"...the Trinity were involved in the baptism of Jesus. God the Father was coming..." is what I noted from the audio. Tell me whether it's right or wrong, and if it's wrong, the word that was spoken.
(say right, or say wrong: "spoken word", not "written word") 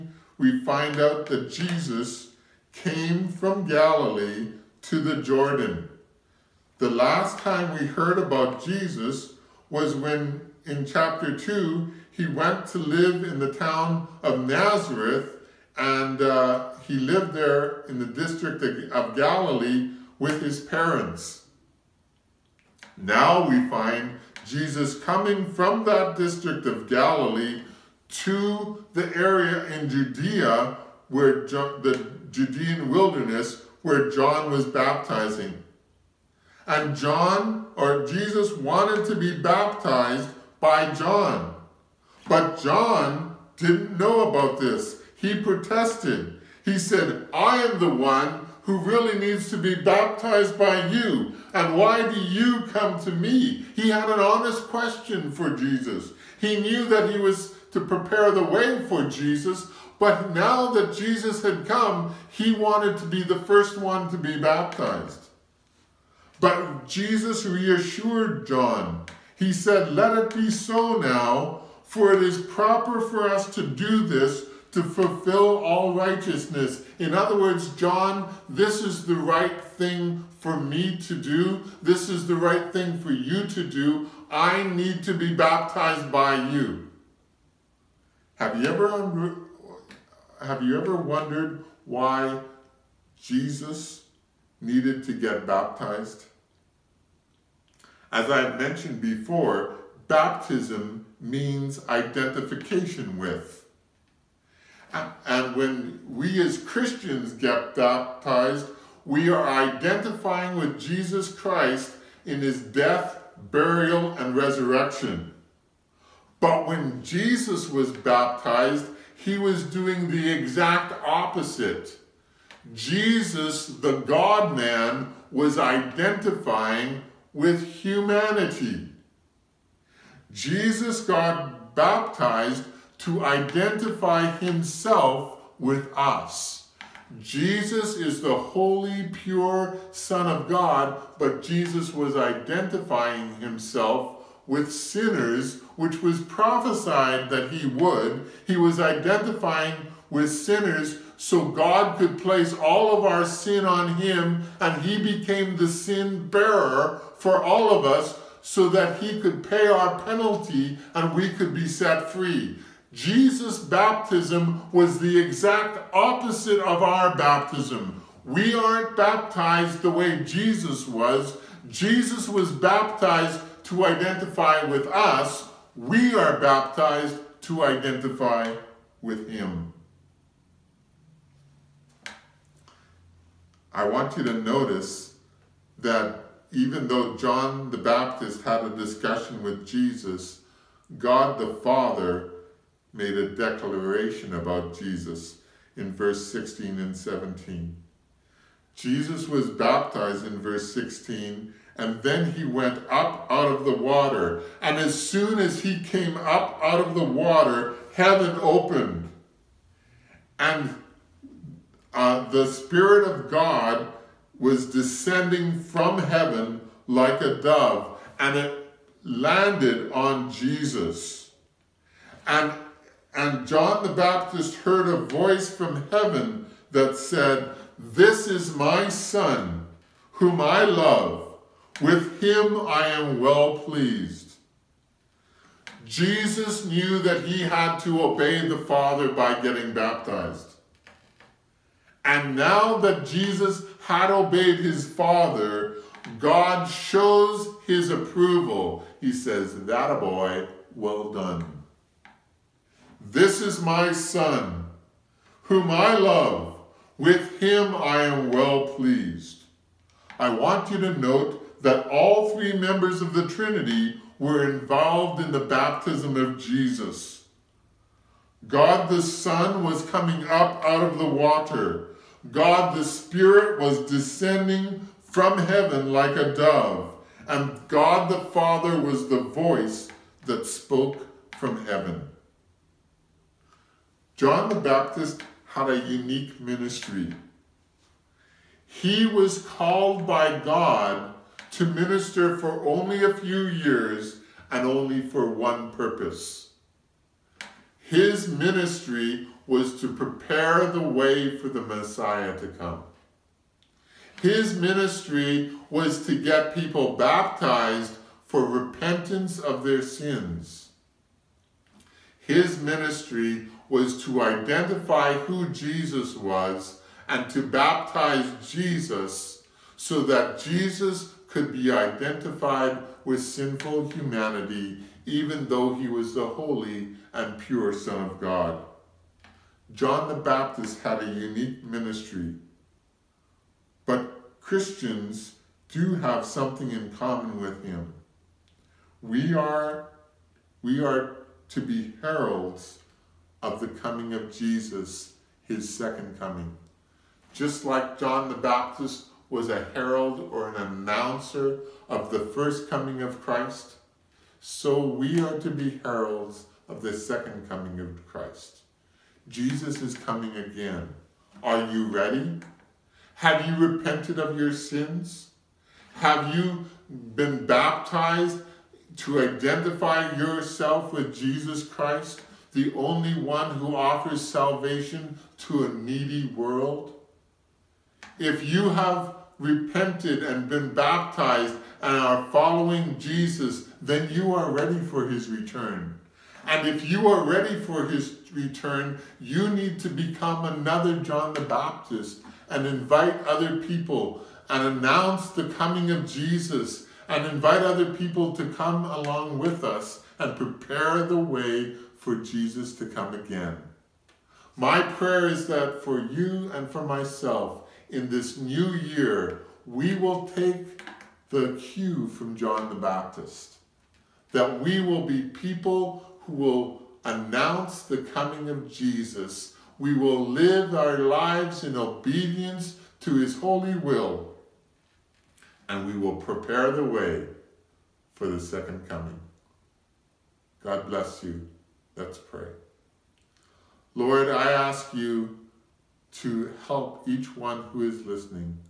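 wrong: "Son", not "Father".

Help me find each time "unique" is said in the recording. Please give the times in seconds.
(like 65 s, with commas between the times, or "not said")
285 s, 331 s.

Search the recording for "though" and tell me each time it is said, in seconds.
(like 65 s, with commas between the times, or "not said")
186 s, 325 s.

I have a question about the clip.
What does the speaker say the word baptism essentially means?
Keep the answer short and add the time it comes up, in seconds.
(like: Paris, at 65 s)
Identification with, at 101 s.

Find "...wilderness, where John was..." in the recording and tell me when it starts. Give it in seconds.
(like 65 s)
32 s.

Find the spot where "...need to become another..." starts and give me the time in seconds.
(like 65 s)
389 s.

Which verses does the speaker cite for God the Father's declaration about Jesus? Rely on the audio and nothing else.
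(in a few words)
16 and 17.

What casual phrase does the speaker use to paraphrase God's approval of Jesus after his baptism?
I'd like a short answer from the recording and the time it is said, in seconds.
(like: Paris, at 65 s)
That a boy, at 249 s.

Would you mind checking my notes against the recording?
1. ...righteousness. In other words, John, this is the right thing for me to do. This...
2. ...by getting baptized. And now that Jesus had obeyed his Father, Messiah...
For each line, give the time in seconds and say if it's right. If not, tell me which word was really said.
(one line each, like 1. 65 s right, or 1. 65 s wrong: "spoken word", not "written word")
1. 75 s right
2. 239 s wrong: "God", not "Messiah".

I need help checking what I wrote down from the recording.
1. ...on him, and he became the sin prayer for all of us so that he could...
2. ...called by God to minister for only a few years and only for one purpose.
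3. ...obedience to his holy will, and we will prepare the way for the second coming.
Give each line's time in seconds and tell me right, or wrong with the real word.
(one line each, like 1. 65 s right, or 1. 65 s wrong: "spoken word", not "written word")
1. 153 s wrong: "bearer", not "prayer"
2. 289 s right
3. 421 s right.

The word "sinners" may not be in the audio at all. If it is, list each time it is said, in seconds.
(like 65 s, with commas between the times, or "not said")
144 s, 150 s.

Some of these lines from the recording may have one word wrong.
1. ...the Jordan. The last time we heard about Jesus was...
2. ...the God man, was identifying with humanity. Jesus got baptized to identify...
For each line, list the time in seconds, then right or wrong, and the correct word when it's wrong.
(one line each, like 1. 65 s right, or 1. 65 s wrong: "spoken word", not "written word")
1. 4 s right
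2. 123 s right.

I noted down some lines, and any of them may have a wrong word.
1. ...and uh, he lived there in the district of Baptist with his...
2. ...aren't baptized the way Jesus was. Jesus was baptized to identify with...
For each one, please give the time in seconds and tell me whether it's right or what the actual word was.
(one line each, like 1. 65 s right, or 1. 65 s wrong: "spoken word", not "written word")
1. 15 s wrong: "Galilee", not "Baptist"
2. 168 s right.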